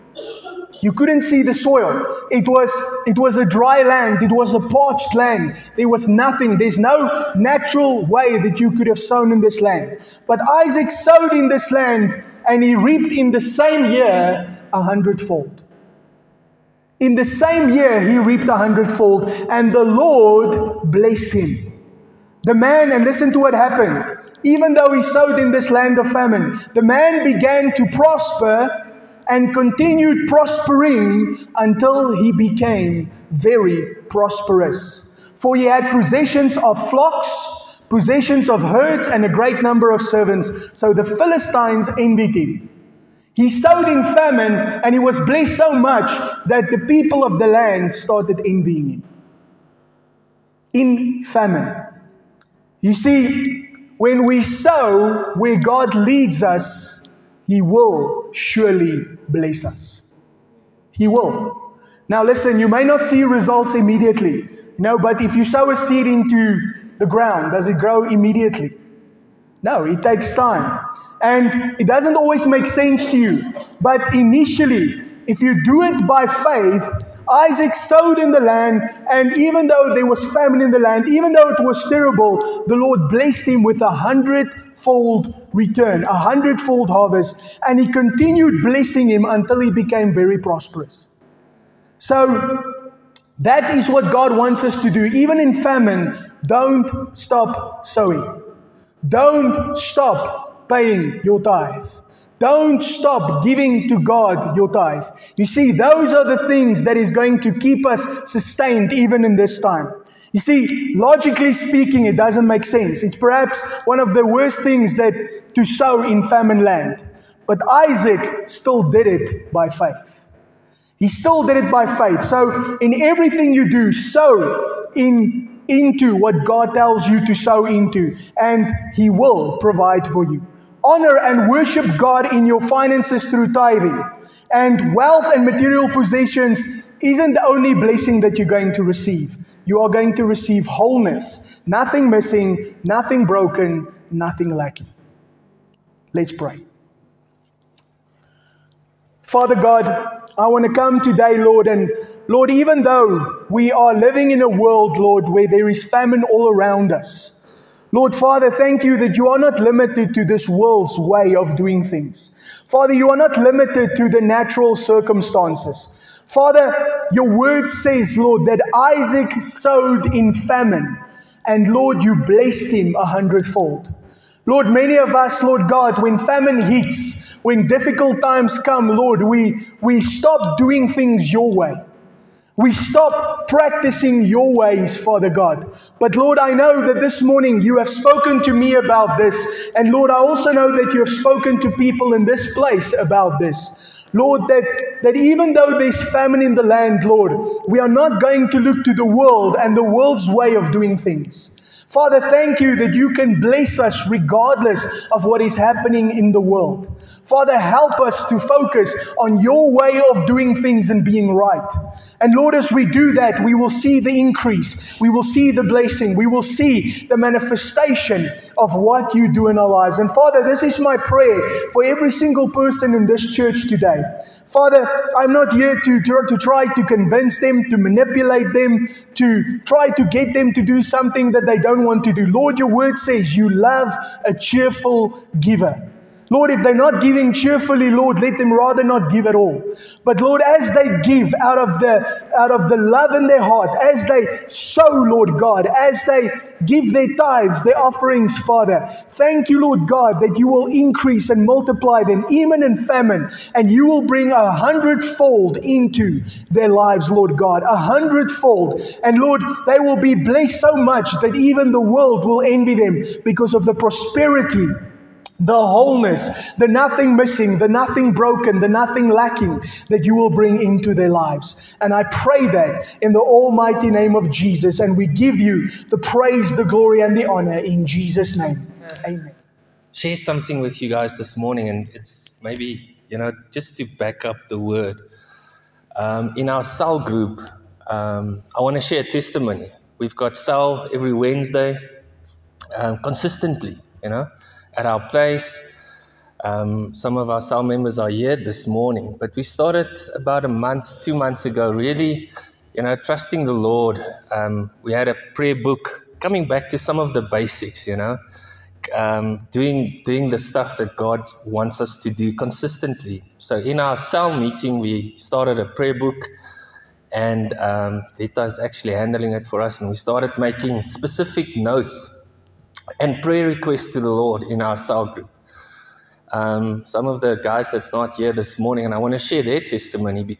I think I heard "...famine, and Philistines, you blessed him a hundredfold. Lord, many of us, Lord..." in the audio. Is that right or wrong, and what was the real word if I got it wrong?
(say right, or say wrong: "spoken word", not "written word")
wrong: "Lord", not "Philistines".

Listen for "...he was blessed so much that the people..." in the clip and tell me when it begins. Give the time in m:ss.
0:44.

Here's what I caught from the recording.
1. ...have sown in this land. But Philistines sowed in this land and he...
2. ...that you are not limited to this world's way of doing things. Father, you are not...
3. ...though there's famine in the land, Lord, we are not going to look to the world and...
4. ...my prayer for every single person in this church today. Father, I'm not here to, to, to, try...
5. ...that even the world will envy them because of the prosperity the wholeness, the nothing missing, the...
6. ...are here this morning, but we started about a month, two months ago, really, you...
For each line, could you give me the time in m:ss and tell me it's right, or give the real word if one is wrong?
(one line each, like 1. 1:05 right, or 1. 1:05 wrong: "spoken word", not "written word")
1. 0:08 wrong: "Isaac", not "Philistines"
2. 2:38 right
3. 3:15 right
4. 3:40 right
5. 4:21 right
6. 4:57 right.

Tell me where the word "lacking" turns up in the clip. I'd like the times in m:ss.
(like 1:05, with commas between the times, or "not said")
2:24, 4:29.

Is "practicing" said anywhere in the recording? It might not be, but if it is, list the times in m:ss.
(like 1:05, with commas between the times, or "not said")
3:03.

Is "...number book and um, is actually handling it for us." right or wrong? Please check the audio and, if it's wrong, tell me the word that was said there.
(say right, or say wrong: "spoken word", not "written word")
wrong: "prayer", not "number".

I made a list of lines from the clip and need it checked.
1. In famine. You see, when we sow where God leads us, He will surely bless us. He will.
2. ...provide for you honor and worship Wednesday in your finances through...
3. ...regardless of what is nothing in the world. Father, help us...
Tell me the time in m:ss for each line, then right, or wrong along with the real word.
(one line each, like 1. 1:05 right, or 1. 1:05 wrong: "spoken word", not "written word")
1. 0:50 right
2. 2:09 wrong: "God", not "Wednesday"
3. 3:24 wrong: "happening", not "nothing".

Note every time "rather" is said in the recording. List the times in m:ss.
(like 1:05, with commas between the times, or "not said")
3:58.